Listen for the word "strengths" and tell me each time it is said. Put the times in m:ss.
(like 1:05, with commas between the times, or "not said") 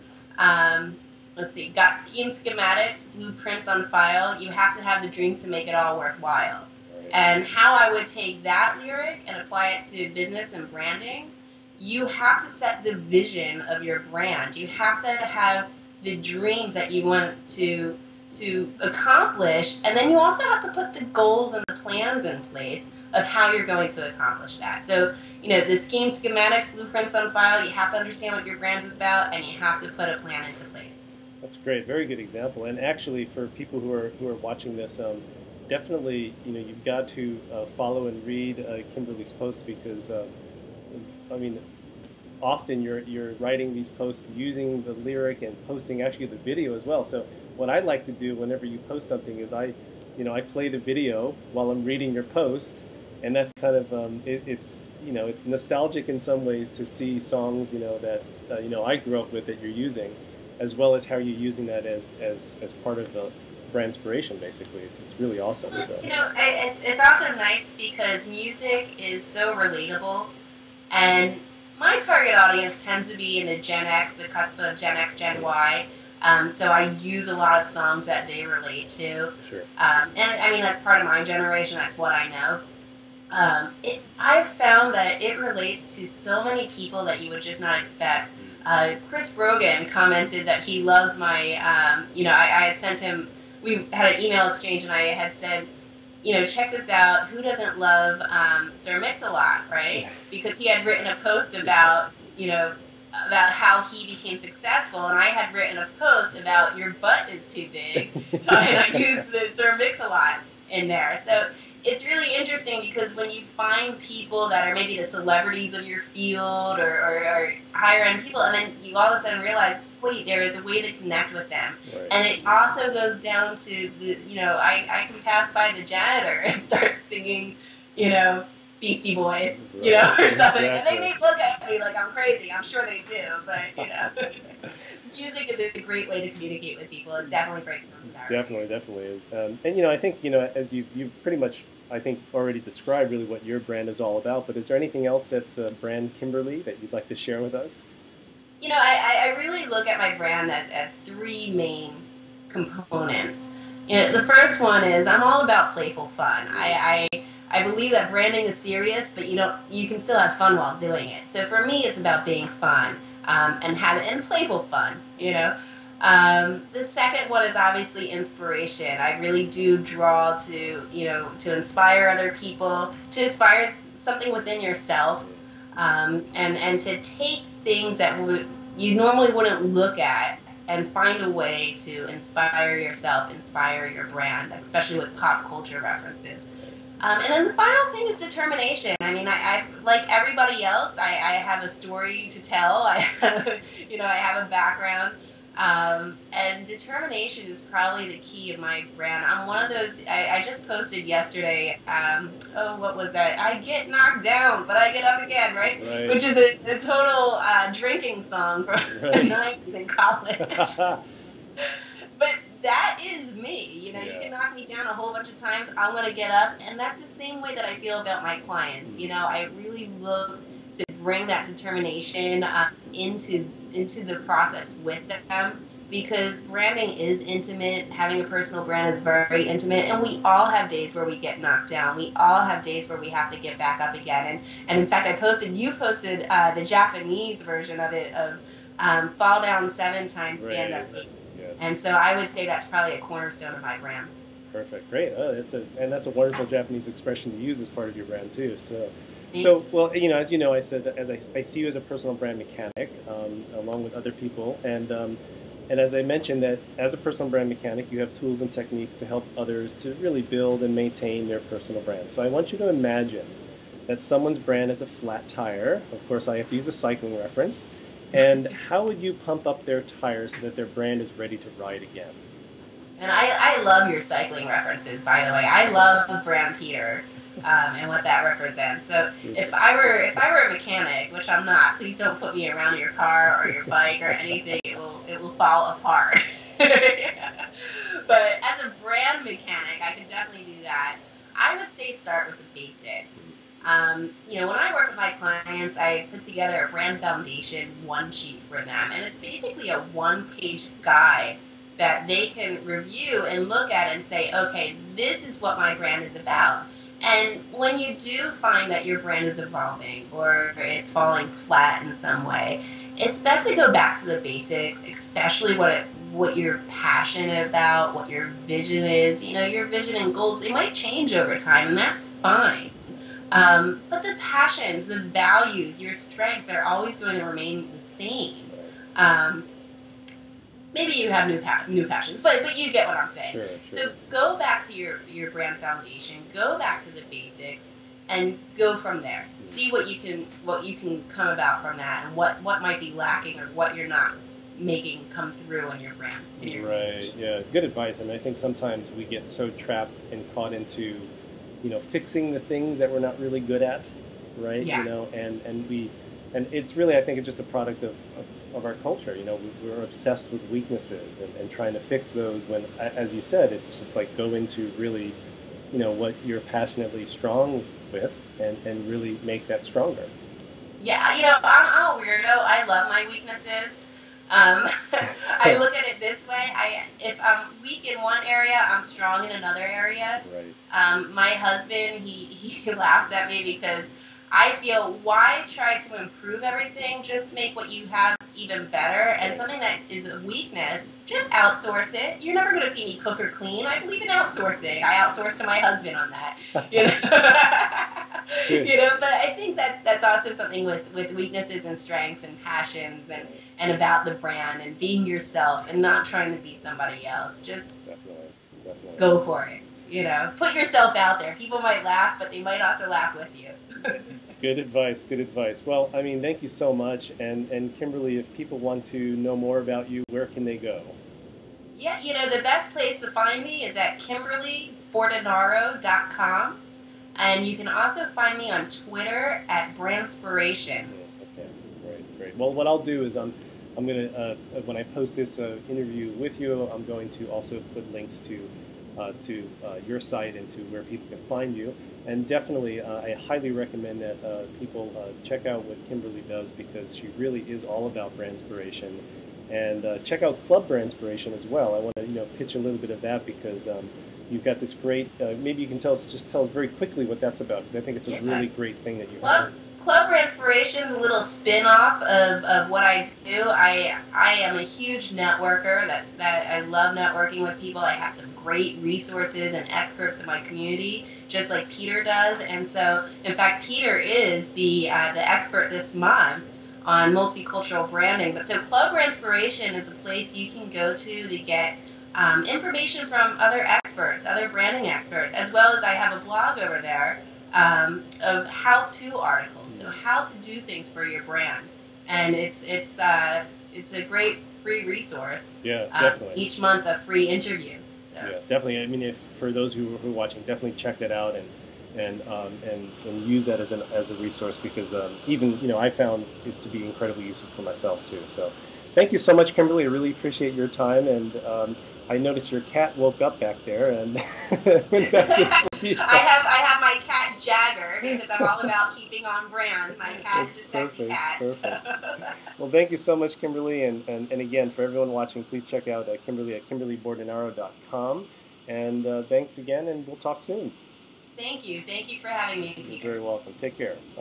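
5:25, 6:41.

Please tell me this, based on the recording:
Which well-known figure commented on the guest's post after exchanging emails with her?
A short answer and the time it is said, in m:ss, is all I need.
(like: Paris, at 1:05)
Chris Brogan, at 1:29.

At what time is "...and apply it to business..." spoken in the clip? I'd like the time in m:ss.
0:09.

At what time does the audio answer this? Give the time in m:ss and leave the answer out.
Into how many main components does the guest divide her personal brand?
2:30.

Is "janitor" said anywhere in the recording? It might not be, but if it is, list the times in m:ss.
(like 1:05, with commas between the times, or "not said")
2:05.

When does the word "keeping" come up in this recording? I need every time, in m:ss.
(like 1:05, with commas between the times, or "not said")
8:38.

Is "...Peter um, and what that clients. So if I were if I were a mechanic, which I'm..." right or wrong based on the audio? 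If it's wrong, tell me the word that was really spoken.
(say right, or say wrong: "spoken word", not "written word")
wrong: "represents", not "clients".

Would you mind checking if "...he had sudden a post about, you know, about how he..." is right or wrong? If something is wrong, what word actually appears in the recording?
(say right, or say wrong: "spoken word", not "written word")
wrong: "written", not "sudden".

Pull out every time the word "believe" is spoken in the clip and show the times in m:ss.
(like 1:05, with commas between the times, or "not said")
2:37, 6:33.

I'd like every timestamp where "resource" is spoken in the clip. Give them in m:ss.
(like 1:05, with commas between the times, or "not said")
7:48, 8:14, 8:24.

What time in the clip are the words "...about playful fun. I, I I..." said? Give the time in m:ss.
2:35.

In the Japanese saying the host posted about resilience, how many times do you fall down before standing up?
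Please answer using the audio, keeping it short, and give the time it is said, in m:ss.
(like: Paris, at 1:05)
7, at 3:59.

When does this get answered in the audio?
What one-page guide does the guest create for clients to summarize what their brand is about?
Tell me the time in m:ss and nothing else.
4:56.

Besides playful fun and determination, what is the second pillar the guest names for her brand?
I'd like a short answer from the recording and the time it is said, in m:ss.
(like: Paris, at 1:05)
inspiration, at 2:48.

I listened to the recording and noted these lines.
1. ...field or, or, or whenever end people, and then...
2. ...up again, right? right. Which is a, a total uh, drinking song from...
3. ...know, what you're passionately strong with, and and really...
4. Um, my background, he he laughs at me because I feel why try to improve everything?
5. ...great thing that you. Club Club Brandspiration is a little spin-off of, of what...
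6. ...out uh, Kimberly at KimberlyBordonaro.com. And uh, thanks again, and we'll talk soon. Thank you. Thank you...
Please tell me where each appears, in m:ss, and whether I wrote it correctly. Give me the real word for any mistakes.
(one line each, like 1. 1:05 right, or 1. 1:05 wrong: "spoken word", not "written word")
1. 1:56 wrong: "higher", not "whenever"
2. 3:25 right
3. 6:05 right
4. 6:20 wrong: "husband", not "background"
5. 7:38 right
6. 8:45 right.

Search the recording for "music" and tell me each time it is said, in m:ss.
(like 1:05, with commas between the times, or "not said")
1:08, 2:15.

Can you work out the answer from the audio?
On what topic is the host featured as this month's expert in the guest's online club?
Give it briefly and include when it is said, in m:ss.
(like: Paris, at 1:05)
multicultural branding, at 7:57.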